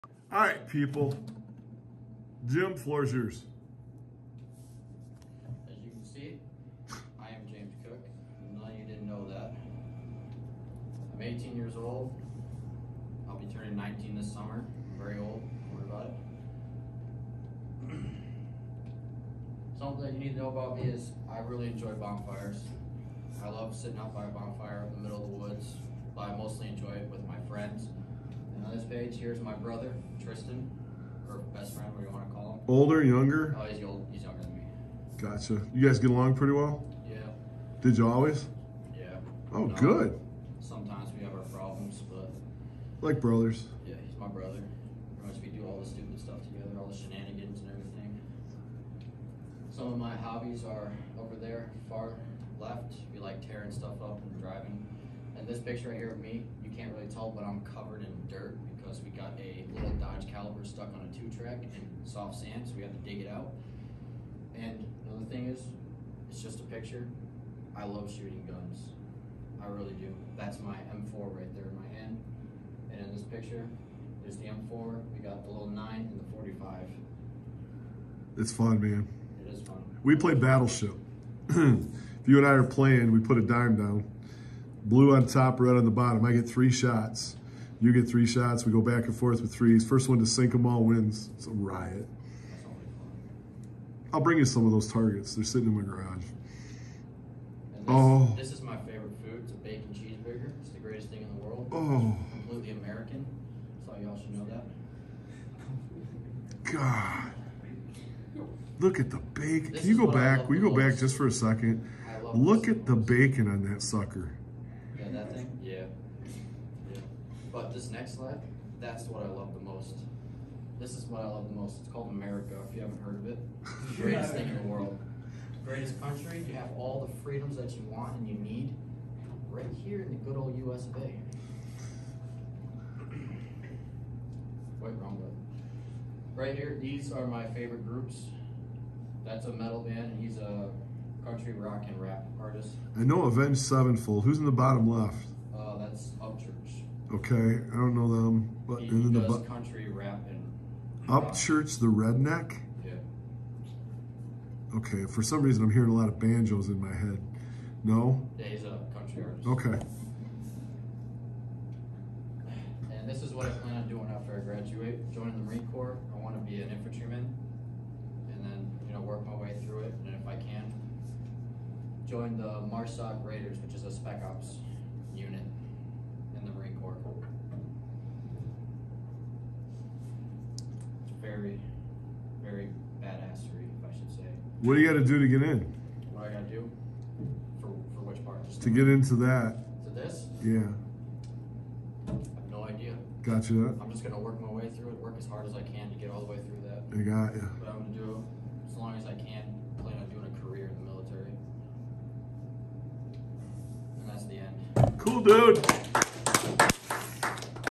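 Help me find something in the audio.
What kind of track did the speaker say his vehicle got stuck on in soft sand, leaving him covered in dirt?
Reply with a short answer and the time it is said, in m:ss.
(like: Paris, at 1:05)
two track, at 1:01.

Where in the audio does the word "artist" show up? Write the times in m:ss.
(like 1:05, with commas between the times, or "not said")
2:22, 2:39.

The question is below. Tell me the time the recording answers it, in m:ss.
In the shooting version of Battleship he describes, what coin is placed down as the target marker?
1:23.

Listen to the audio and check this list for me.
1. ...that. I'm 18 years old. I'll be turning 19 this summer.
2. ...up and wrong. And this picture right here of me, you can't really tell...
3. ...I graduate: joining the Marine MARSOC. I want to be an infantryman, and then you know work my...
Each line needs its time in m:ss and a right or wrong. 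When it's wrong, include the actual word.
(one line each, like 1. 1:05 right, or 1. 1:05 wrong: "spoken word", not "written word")
1. 0:09 right
2. 0:54 wrong: "driving", not "wrong"
3. 2:44 wrong: "Corps", not "MARSOC".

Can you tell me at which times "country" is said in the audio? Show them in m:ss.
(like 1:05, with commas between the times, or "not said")
2:06, 2:21, 2:29, 2:38.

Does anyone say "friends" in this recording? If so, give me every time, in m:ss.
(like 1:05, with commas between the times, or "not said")
0:27, 0:31.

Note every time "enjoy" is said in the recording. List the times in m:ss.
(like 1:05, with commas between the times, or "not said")
0:21, 0:26.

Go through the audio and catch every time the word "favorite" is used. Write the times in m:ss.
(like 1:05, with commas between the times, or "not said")
1:38, 2:17.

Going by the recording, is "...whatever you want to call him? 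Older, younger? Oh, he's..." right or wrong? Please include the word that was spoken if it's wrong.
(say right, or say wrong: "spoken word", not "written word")
right.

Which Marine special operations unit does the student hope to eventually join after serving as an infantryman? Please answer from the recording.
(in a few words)
MARSOC Raiders.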